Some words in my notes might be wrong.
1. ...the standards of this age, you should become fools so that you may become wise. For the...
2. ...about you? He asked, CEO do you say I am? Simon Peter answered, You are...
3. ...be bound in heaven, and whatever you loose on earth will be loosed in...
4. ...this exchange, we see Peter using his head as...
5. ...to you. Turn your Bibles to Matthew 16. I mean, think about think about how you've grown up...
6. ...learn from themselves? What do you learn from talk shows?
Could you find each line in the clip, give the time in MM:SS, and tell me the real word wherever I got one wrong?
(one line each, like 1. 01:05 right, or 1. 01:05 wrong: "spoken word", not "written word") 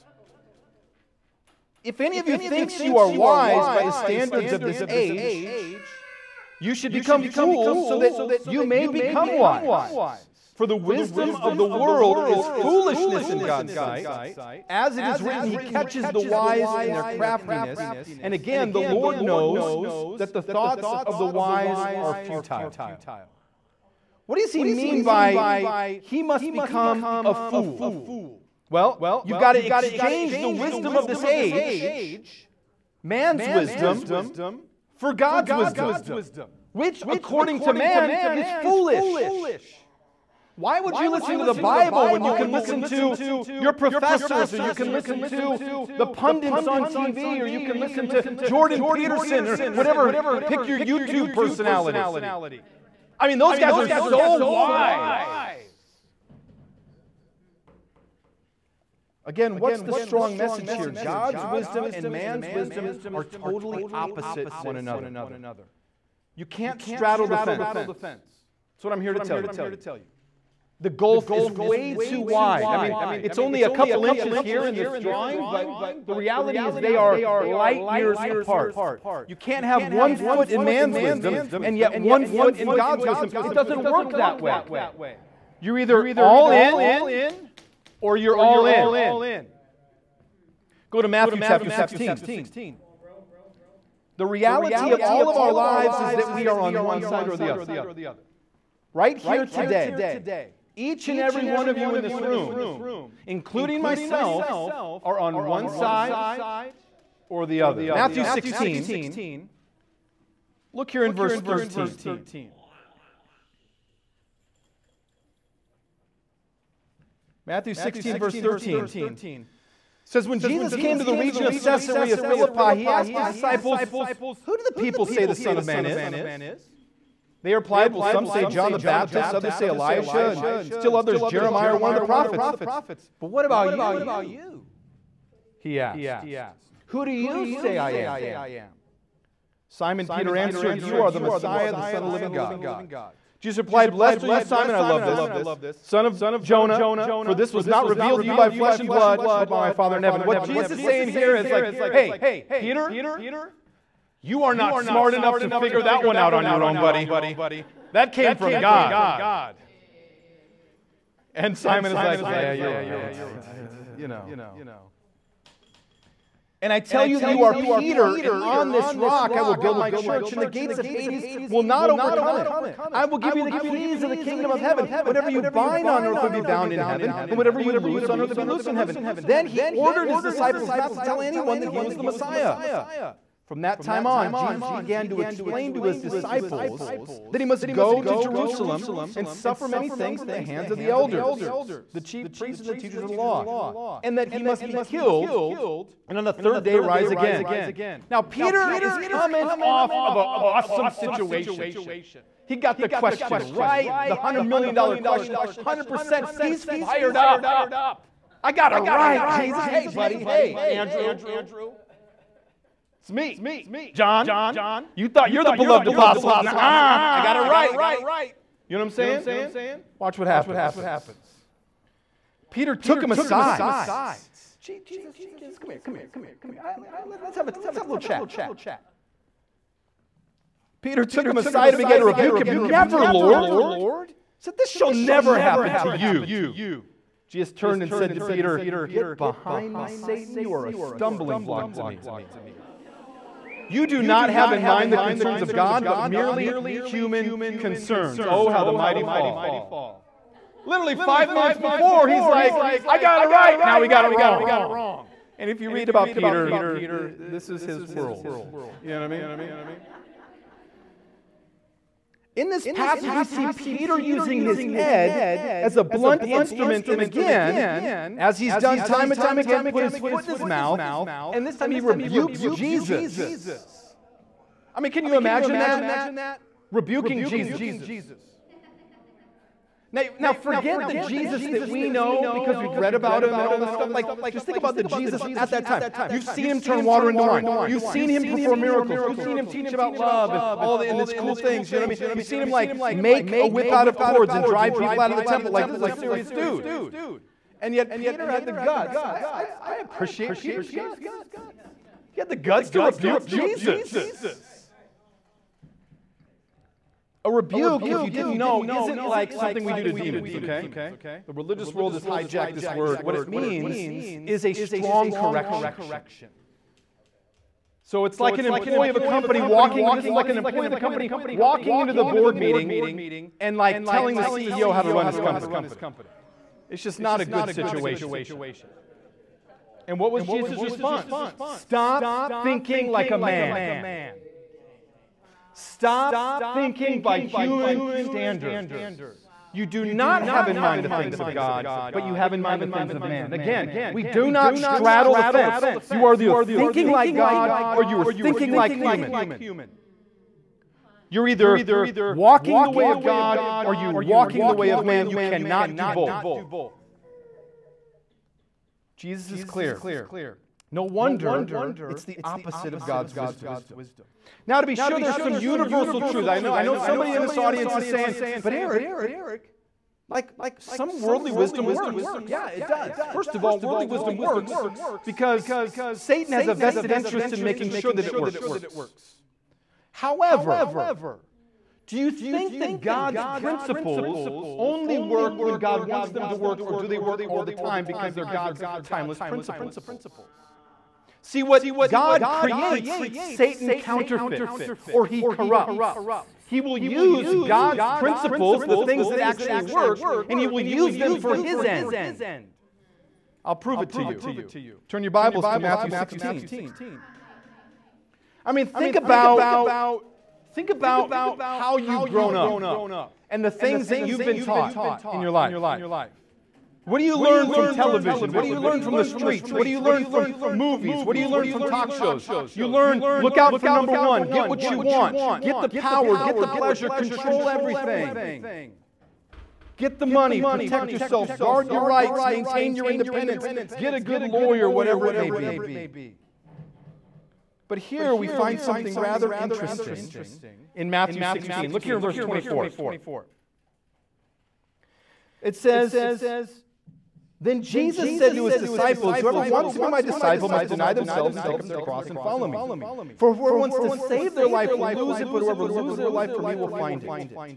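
1. 00:03 right
2. 02:13 wrong: "Who", not "CEO"
3. 02:56 right
4. 04:22 wrong: "passage", not "exchange"
5. 06:43 right
6. 06:59 wrong: "movies", not "themselves".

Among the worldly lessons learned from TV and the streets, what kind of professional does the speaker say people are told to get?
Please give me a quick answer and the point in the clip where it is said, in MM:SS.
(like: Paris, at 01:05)
a good lawyer, at 07:13.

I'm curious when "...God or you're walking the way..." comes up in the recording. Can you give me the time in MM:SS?
05:53.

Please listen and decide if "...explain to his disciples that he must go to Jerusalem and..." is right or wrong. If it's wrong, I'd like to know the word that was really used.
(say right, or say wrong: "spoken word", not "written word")
right.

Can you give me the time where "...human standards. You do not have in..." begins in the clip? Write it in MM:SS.
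05:37.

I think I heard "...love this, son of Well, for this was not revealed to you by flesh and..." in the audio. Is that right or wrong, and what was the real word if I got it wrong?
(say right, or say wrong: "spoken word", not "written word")
wrong: "Jonah", not "Well".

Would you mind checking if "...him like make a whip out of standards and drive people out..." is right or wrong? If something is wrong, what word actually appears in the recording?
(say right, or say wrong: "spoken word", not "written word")
wrong: "cords", not "standards".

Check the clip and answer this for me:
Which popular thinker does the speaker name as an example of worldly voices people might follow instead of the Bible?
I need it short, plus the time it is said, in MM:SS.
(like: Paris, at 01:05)
Jordan Peterson, at 00:48.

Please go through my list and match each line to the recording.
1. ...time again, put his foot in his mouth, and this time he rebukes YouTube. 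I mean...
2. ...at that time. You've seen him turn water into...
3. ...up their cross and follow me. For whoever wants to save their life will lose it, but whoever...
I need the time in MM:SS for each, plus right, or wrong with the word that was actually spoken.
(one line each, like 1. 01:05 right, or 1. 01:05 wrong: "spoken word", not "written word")
1. 04:29 wrong: "Jesus", not "YouTube"
2. 04:45 right
3. 07:31 right.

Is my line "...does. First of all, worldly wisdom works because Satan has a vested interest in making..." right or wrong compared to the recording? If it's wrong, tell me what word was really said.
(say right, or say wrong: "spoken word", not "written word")
right.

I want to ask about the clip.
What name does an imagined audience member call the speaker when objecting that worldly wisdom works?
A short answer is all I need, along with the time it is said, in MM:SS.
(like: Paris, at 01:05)
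Eric, at 06:08.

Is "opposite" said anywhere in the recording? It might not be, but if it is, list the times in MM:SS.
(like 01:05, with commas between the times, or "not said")
01:03, 06:02.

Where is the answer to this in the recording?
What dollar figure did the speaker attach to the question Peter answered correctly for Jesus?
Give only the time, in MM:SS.
03:24.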